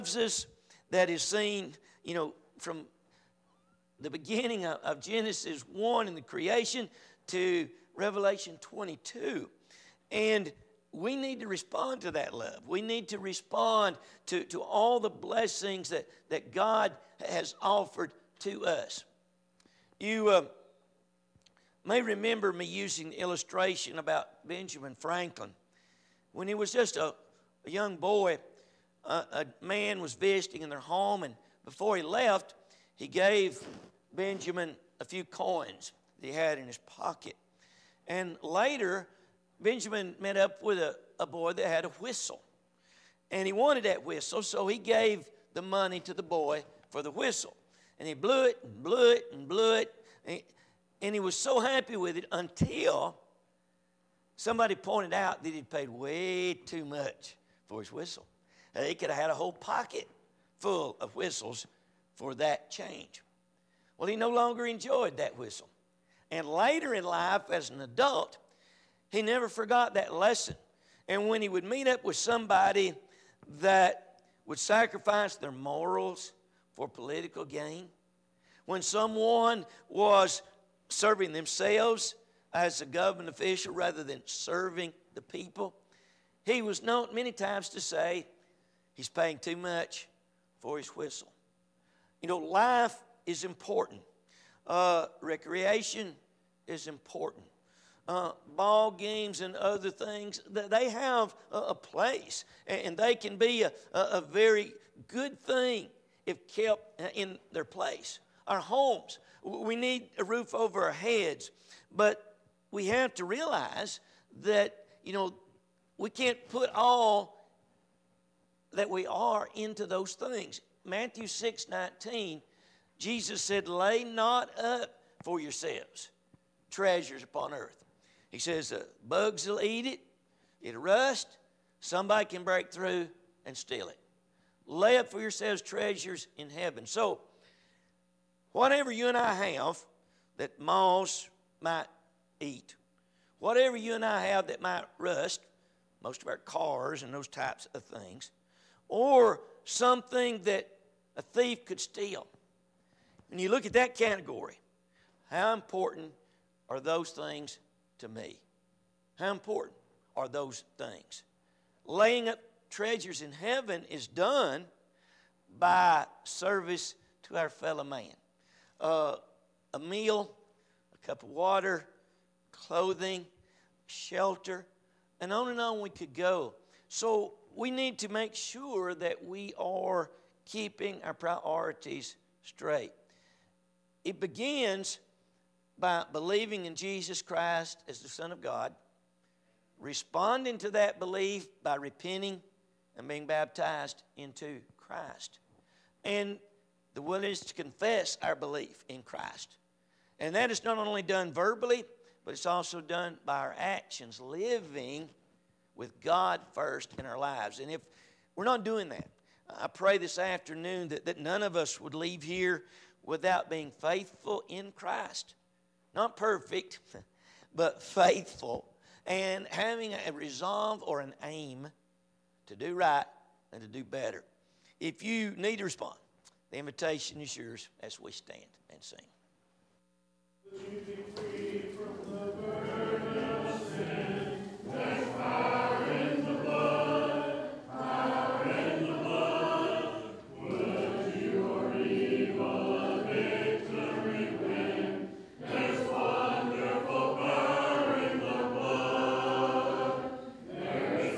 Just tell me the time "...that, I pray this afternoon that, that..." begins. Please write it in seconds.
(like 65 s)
208 s.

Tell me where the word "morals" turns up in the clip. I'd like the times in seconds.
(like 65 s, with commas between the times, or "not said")
75 s.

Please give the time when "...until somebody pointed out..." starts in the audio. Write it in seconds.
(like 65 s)
52 s.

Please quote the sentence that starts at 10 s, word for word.
And we need to respond to that love.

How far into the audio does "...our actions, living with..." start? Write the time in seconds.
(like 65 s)
203 s.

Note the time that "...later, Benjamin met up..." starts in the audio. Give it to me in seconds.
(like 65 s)
38 s.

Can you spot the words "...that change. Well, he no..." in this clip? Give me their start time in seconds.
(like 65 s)
62 s.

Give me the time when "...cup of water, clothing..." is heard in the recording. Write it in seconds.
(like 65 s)
171 s.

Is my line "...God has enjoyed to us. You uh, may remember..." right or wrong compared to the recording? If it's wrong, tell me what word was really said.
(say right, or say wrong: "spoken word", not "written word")
wrong: "offered", not "enjoyed".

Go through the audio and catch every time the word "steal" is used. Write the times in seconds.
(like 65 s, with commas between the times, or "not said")
133 s, 151 s.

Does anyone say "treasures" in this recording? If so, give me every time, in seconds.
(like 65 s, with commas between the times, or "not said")
126 s, 135 s, 162 s.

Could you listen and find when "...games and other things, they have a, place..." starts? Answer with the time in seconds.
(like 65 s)
98 s.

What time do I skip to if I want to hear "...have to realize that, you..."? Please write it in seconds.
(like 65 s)
112 s.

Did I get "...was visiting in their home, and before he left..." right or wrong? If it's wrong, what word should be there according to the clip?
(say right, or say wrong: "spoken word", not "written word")
right.